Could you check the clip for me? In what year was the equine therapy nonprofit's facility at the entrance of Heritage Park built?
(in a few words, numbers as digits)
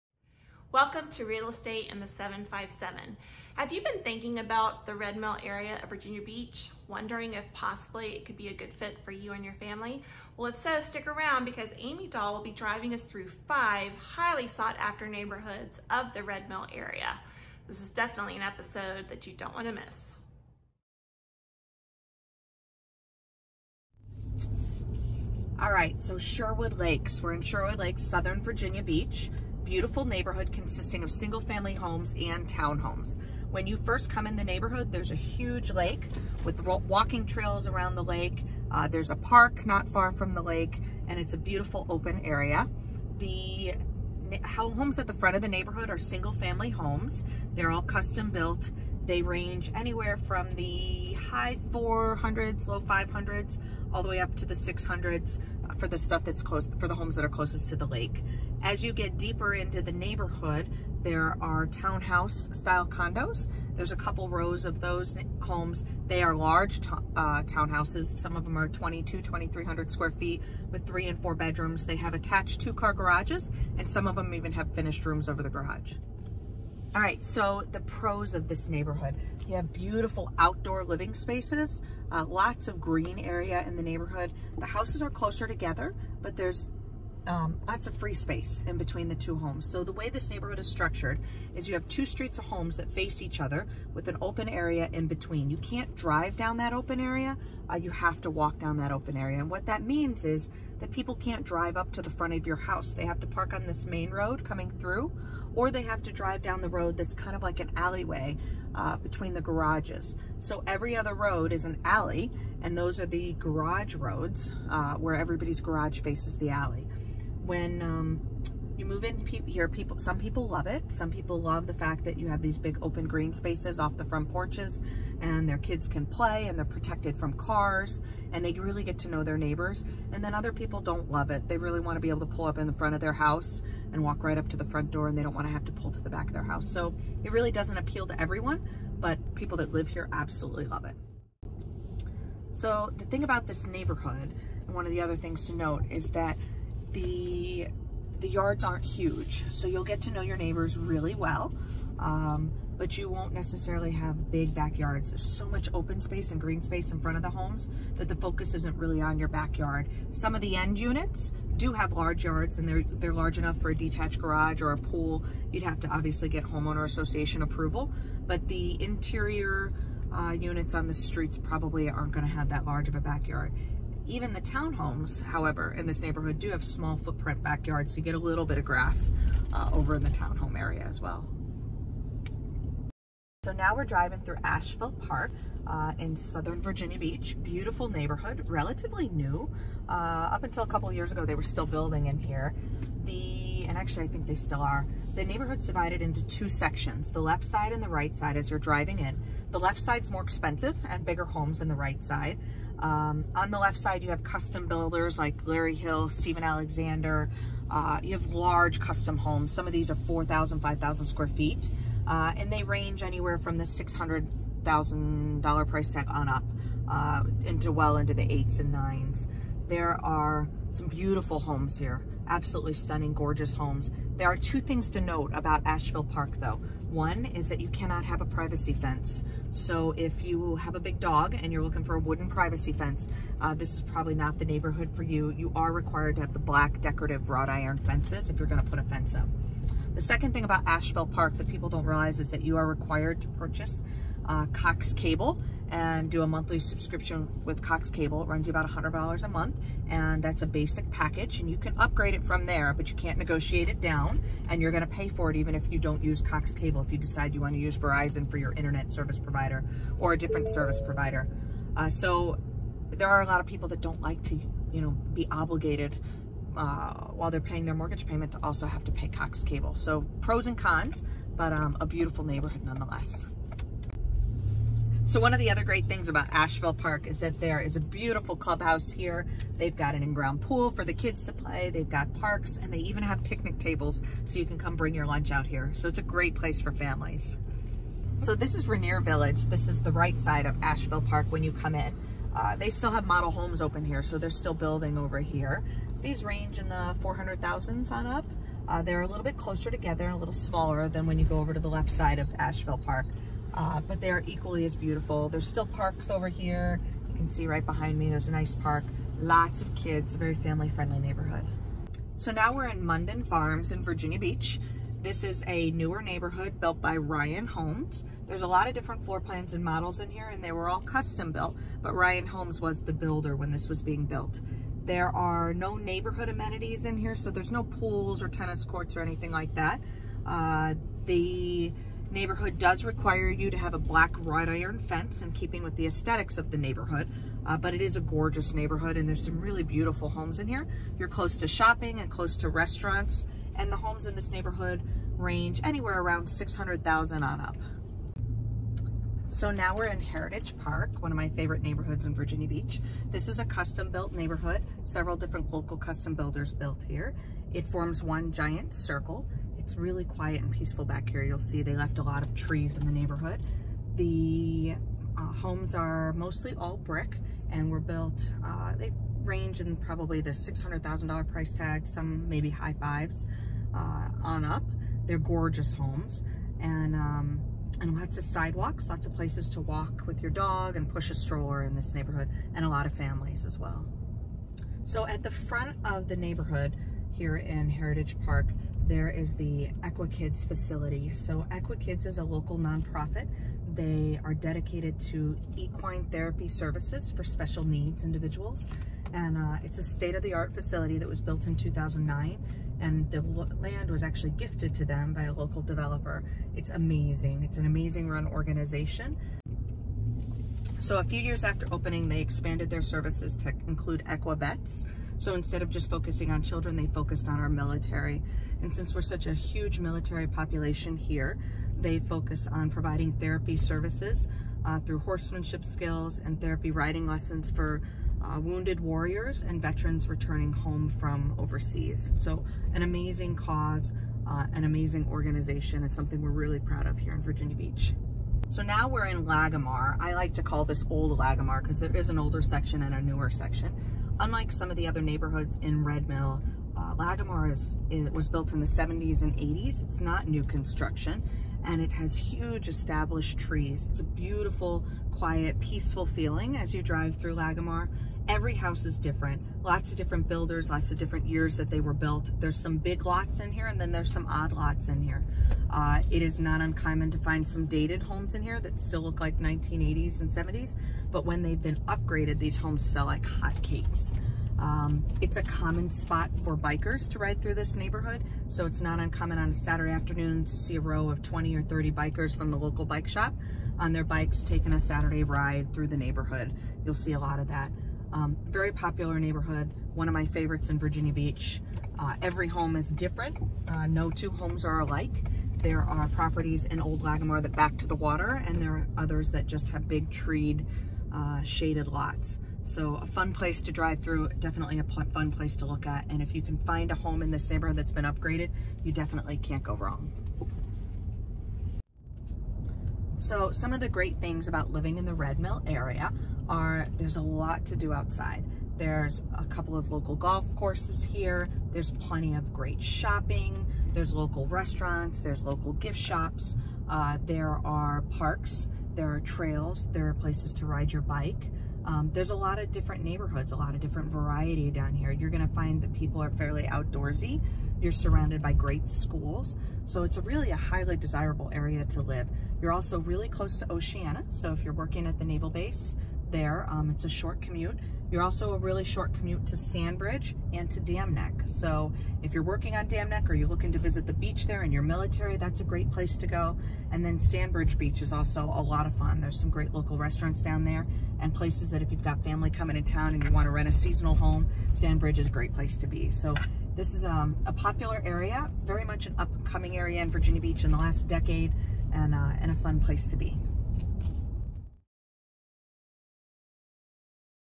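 2009.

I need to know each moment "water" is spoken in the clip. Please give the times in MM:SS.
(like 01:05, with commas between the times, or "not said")
08:17.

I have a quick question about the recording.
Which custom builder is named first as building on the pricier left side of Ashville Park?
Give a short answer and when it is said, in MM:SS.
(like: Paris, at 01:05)
Larry Hill, at 03:25.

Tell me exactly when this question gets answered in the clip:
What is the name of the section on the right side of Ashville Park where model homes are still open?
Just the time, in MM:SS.
04:48.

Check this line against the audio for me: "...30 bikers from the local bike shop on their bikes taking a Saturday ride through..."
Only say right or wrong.
right.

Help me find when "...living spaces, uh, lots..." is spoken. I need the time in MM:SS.
01:20.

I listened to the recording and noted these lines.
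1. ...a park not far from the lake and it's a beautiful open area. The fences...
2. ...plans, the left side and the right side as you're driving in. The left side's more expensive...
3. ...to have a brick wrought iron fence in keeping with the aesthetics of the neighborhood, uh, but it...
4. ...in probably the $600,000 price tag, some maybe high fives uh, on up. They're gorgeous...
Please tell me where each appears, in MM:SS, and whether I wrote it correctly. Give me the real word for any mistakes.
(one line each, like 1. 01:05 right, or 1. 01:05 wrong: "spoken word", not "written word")
1. 00:39 wrong: "homes", not "fences"
2. 03:16 wrong: "sections", not "plans"
3. 05:33 wrong: "black", not "brick"
4. 06:09 right.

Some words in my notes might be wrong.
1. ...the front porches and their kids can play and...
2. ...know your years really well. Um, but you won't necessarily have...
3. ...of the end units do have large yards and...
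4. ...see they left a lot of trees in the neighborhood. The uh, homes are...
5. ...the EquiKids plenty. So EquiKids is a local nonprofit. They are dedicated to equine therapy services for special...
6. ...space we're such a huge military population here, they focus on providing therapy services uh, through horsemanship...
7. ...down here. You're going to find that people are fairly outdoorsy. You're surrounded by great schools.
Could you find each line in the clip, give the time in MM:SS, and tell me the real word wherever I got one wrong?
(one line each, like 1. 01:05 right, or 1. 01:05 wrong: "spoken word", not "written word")
1. 02:03 right
2. 02:30 wrong: "neighbors", not "years"
3. 02:40 right
4. 06:01 right
5. 06:29 wrong: "facility", not "plenty"
6. 06:58 wrong: "since", not "space"
7. 08:54 right.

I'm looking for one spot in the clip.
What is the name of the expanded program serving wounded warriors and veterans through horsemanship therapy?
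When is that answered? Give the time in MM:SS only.
06:54.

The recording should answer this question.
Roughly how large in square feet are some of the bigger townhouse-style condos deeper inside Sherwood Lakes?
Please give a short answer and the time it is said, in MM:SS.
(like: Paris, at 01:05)
2,300, at 01:09.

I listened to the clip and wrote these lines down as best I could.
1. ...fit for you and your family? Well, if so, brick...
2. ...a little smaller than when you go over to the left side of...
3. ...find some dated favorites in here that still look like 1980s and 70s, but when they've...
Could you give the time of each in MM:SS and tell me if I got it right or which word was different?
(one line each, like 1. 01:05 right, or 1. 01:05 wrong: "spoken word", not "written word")
1. 00:08 wrong: "stick", not "brick"
2. 05:00 right
3. 07:47 wrong: "homes", not "favorites".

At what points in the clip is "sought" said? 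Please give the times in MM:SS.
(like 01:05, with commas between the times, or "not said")
00:14.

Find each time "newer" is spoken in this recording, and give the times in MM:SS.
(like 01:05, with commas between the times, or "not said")
05:15, 07:23.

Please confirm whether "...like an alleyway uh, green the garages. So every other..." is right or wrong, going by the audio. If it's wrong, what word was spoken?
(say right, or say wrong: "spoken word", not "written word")
wrong: "between", not "green".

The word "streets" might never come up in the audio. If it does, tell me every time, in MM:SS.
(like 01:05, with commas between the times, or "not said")
01:32, 02:50.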